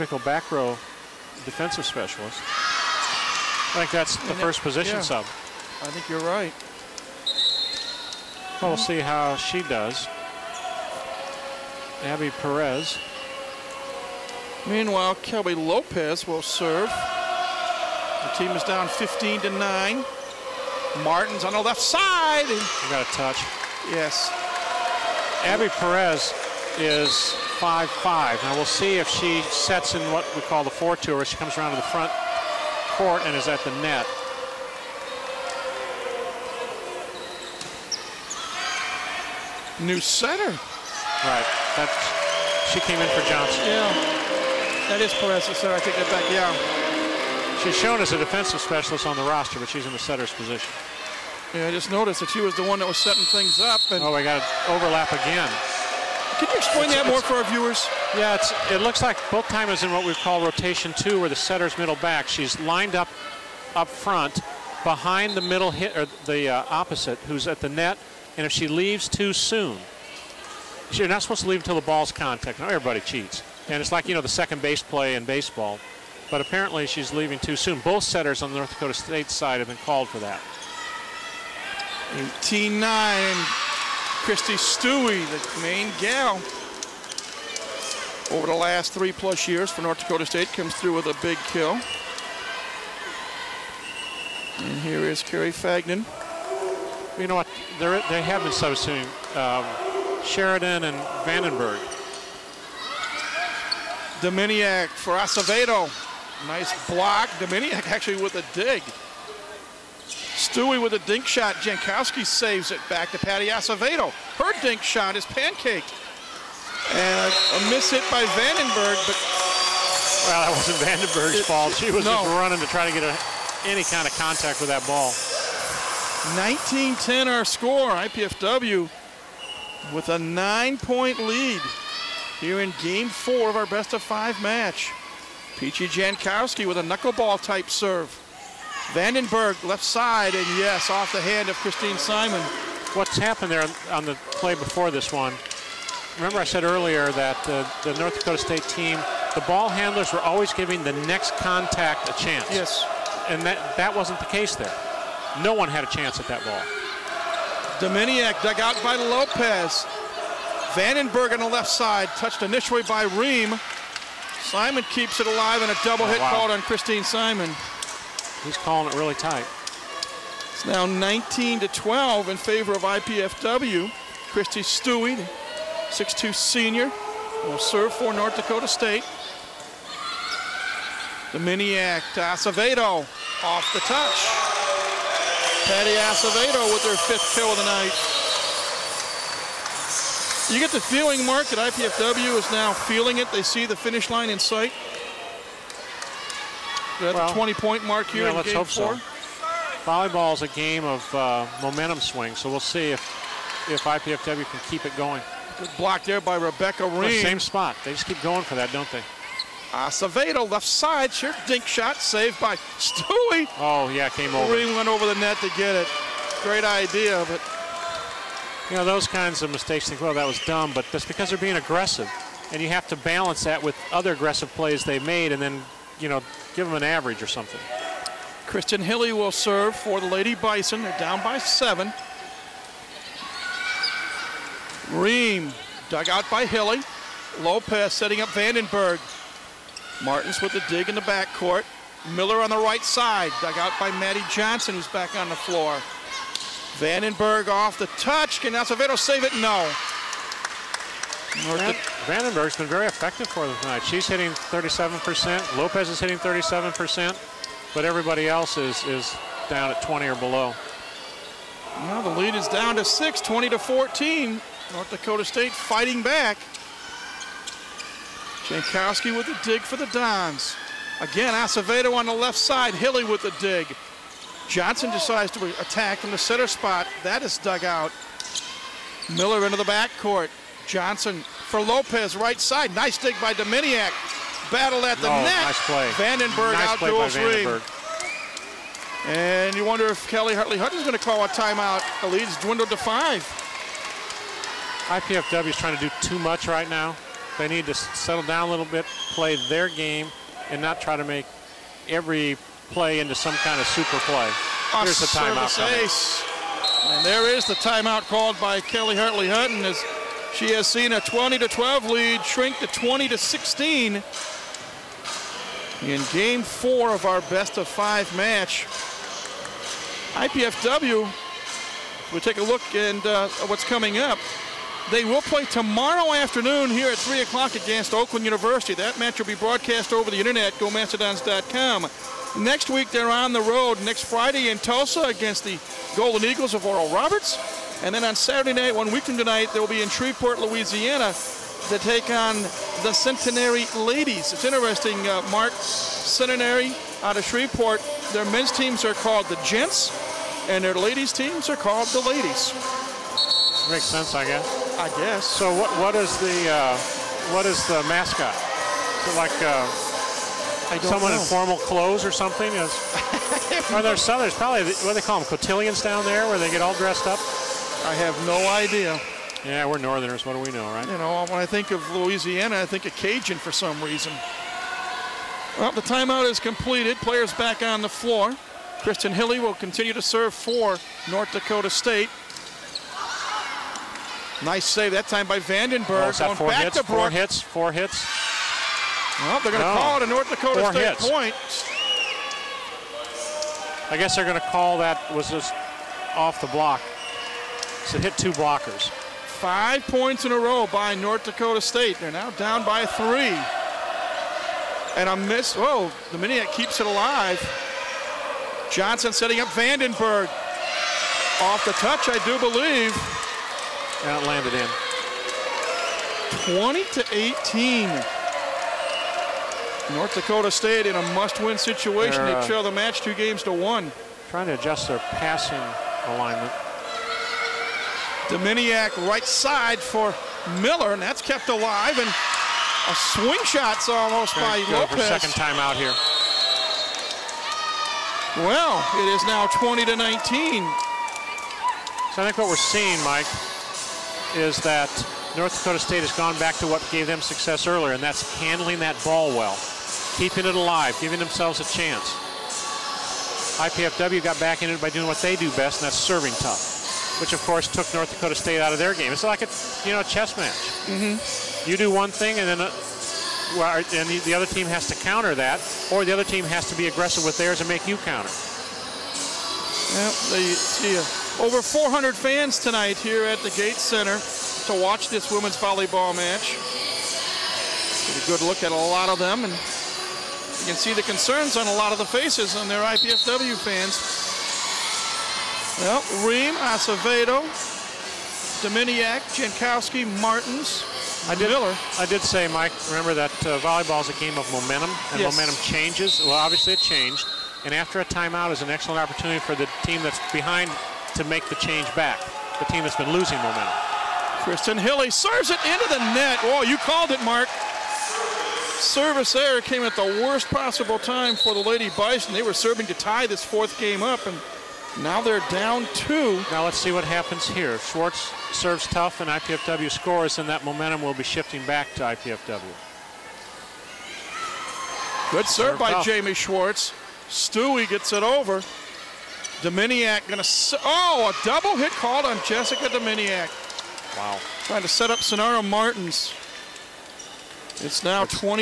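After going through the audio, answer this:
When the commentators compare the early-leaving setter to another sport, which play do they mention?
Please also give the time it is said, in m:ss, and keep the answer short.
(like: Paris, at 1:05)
second base play, at 1:14.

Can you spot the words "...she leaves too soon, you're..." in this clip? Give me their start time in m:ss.
1:08.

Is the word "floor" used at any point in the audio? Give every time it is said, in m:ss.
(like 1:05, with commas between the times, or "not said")
4:05, 6:17.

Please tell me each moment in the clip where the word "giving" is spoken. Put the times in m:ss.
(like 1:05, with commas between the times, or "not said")
2:30, 7:31.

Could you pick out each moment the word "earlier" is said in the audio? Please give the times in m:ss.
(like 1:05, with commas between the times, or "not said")
2:26, 7:27.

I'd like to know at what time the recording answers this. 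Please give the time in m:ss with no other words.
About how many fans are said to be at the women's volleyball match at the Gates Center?
7:51.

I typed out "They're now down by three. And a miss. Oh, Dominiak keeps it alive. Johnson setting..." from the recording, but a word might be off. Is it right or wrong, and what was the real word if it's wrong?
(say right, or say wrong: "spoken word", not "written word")
right.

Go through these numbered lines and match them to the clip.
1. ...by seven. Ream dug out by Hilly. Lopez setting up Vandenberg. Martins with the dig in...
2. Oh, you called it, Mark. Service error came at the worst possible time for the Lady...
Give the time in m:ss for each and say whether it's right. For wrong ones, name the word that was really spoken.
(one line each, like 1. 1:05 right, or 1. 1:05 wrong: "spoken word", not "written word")
1. 3:51 right
2. 8:26 right.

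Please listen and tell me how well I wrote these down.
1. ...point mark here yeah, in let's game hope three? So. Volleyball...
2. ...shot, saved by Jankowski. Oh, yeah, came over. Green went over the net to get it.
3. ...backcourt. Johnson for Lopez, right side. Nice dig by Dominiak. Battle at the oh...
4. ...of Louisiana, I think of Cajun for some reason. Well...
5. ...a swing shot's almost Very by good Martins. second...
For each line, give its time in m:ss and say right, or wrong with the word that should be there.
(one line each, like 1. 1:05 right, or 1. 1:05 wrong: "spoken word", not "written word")
1. 3:17 wrong: "four", not "three"
2. 3:31 wrong: "Stewie", not "Jankowski"
3. 4:39 right
4. 6:11 right
5. 7:12 wrong: "Lopez", not "Martins".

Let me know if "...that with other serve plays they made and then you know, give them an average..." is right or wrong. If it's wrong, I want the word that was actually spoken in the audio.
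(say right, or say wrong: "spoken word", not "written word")
wrong: "aggressive", not "serve".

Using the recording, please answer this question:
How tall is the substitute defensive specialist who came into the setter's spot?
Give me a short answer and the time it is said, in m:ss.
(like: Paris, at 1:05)
5'5", at 0:27.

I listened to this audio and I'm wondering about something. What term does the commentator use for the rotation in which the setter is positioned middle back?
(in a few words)
rotation two.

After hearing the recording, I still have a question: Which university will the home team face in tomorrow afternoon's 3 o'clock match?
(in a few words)
Oakland University.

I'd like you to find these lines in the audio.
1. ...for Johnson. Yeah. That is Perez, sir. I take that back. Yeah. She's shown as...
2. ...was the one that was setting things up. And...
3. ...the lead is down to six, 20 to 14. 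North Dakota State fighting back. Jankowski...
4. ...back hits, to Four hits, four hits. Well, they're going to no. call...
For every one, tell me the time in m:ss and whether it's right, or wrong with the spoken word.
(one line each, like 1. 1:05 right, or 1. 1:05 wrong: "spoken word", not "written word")
1. 0:43 right
2. 0:52 right
3. 4:22 right
4. 6:26 right.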